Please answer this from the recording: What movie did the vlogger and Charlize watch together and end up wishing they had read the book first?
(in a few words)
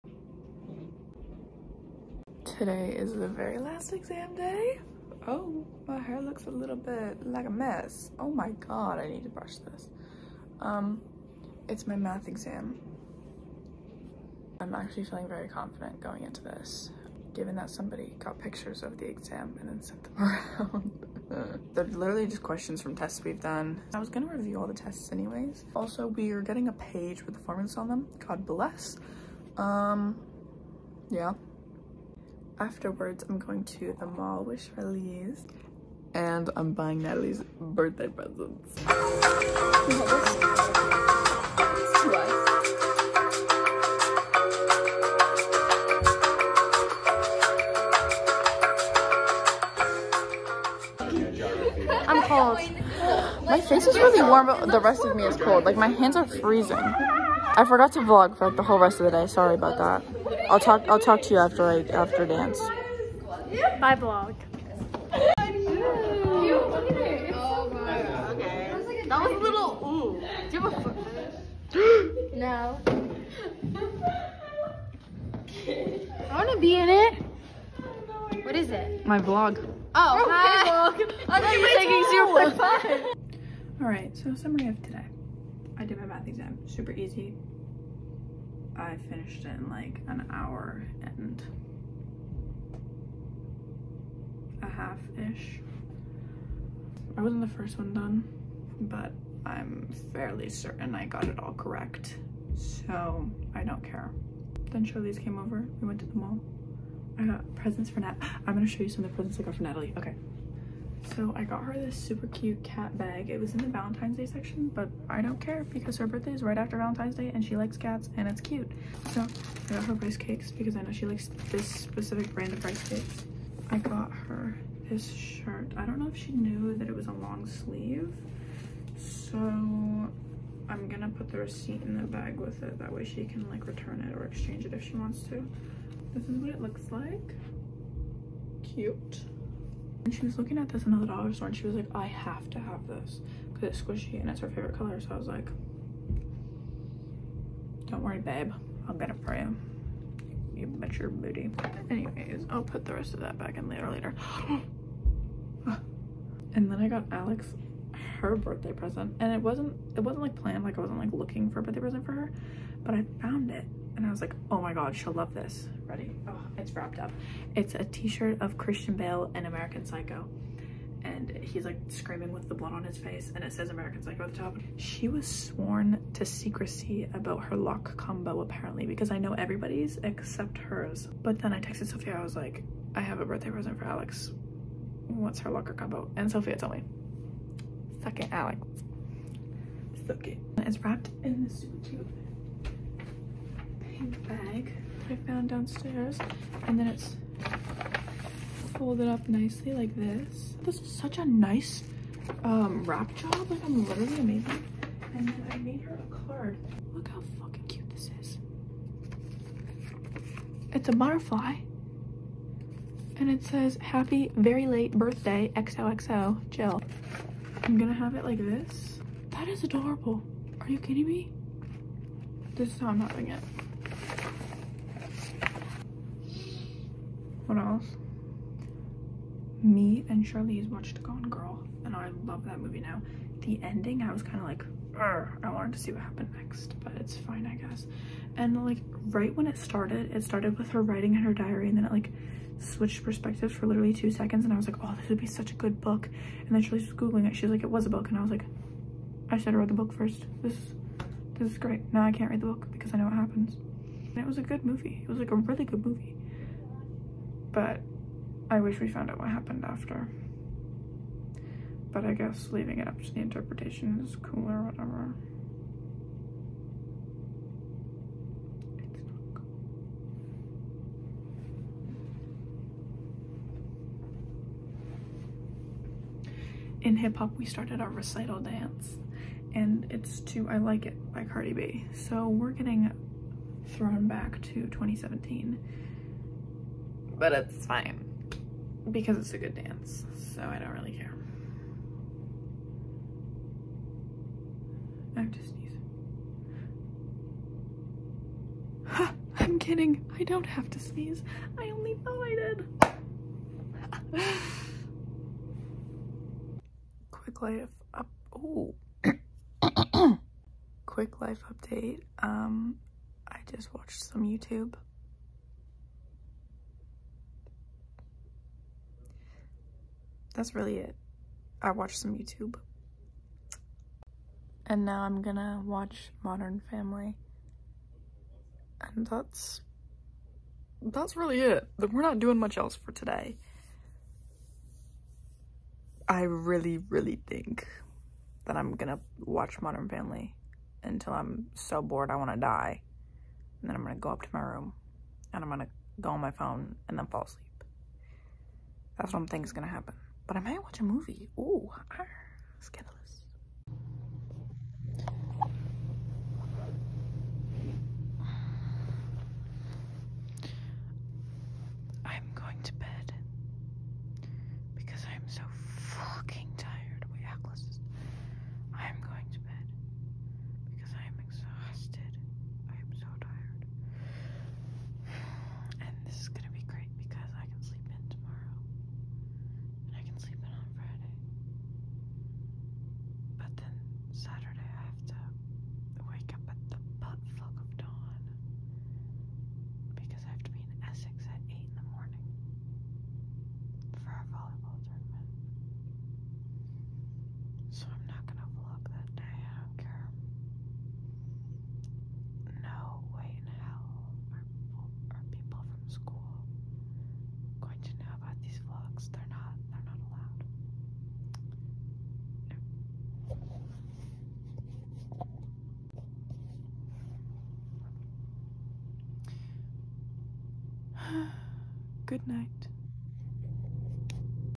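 Gone Girl.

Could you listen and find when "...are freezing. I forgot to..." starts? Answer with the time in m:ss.
0:56.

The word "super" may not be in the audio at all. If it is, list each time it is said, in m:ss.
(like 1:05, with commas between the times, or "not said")
1:26, 1:51, 3:11.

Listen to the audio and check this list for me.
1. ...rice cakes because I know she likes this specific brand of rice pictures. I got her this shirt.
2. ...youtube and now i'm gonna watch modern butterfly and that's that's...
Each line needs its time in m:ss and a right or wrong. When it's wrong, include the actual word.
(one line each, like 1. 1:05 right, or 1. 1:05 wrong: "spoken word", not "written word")
1. 1:59 wrong: "cakes", not "pictures"
2. 5:22 wrong: "family", not "butterfly".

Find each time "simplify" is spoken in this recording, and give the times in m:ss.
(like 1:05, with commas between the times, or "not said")
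not said.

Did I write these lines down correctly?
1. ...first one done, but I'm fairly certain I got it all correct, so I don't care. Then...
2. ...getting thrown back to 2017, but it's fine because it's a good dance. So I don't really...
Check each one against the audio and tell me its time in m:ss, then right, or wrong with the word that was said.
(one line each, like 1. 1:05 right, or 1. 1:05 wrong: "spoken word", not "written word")
1. 1:37 right
2. 4:42 right.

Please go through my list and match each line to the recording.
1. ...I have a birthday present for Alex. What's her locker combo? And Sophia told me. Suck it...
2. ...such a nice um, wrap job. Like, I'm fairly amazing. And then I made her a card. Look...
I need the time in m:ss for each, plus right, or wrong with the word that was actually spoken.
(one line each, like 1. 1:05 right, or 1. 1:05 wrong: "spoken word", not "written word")
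1. 3:02 right
2. 3:20 wrong: "literally", not "fairly".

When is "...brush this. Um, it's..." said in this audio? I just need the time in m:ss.
0:09.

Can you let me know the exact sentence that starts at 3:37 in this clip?
I'm gonna have it like this.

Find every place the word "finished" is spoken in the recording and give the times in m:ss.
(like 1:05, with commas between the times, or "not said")
1:29.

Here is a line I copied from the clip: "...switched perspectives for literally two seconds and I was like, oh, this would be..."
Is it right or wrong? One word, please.
right.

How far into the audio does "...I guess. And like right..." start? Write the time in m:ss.
3:57.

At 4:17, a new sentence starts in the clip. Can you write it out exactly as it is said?
But I wish we found out what happened after.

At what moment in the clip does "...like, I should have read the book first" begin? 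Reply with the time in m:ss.
4:08.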